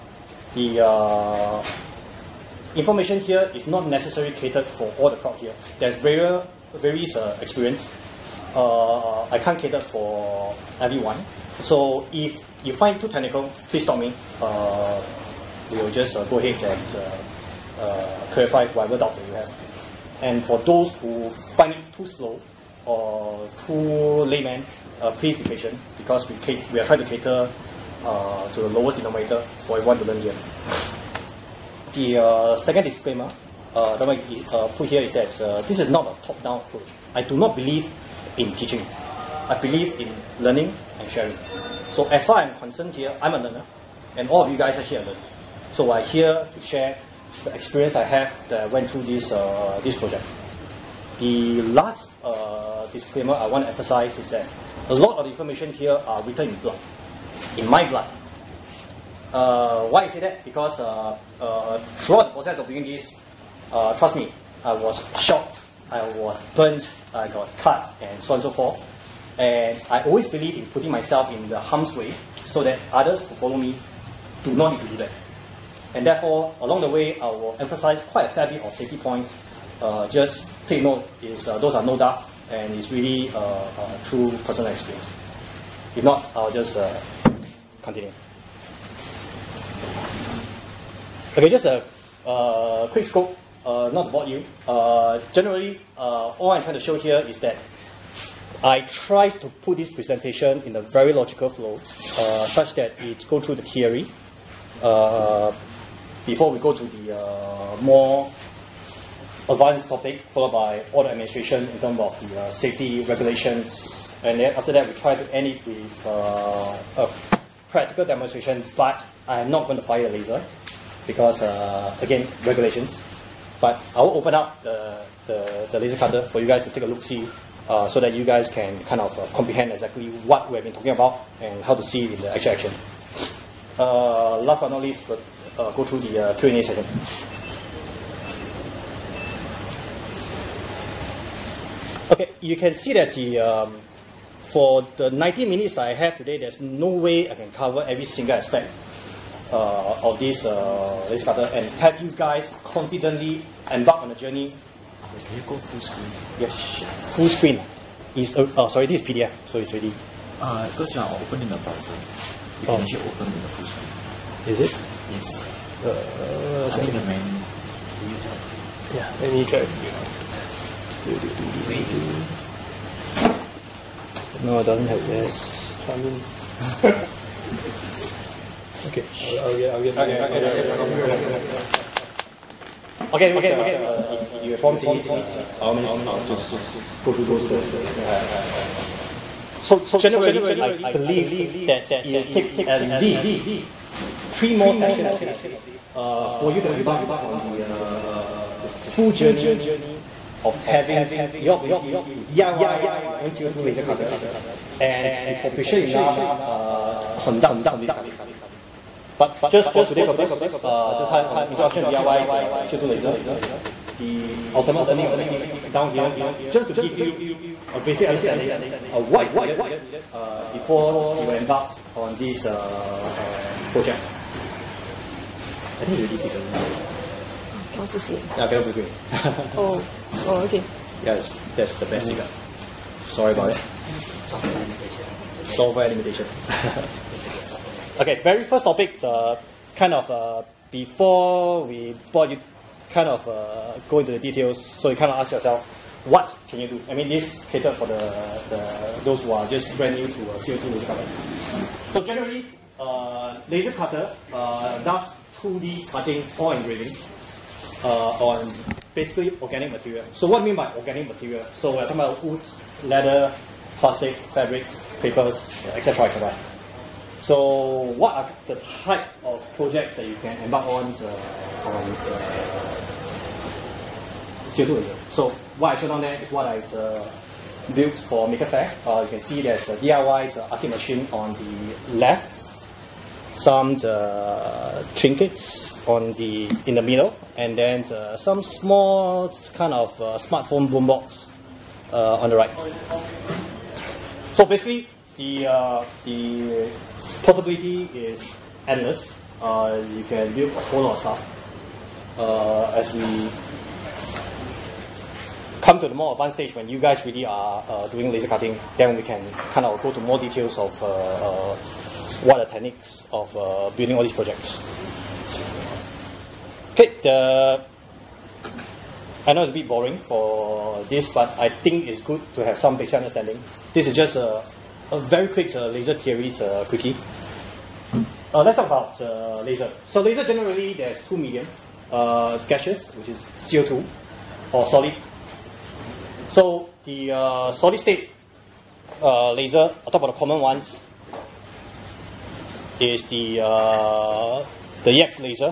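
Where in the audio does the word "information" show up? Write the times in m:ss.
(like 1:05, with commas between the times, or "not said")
0:02, 0:55.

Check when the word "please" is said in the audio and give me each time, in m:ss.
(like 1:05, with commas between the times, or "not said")
0:13, 0:25.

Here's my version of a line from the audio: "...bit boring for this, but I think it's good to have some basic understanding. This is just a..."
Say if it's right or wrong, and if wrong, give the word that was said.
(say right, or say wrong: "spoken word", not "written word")
right.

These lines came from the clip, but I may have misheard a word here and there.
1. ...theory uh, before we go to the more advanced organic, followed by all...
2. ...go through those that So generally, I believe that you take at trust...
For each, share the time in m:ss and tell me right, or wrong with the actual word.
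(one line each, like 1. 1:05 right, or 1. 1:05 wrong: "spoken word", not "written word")
1. 1:43 wrong: "topic", not "organic"
2. 3:07 wrong: "least", not "trust".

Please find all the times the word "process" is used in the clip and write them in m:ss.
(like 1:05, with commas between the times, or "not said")
1:02.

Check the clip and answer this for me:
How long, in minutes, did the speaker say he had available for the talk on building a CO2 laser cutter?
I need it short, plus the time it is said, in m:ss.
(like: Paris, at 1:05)
90, at 2:25.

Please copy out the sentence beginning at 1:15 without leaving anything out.
And therefore, along the way, I will emphasize quite a fair bit of safety points.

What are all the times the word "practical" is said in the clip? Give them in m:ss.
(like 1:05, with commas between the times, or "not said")
1:57.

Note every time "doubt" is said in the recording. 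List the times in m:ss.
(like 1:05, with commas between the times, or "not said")
0:18, 1:21.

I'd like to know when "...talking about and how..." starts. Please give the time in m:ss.
2:10.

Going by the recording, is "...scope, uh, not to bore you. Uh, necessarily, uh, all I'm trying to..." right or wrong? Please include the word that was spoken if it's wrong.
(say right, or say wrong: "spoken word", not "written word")
wrong: "generally", not "necessarily".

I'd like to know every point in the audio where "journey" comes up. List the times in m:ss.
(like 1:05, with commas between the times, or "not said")
2:34, 3:19.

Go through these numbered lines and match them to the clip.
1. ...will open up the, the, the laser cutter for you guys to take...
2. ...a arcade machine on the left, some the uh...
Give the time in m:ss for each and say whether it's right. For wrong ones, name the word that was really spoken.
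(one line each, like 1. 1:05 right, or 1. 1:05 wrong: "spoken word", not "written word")
1. 2:04 right
2. 4:40 right.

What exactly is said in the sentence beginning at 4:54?
So basically, the the possibility is endless.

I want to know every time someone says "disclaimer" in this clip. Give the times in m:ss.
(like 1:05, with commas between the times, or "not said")
0:32, 0:52.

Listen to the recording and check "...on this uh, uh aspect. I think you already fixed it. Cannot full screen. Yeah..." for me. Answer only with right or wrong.
wrong.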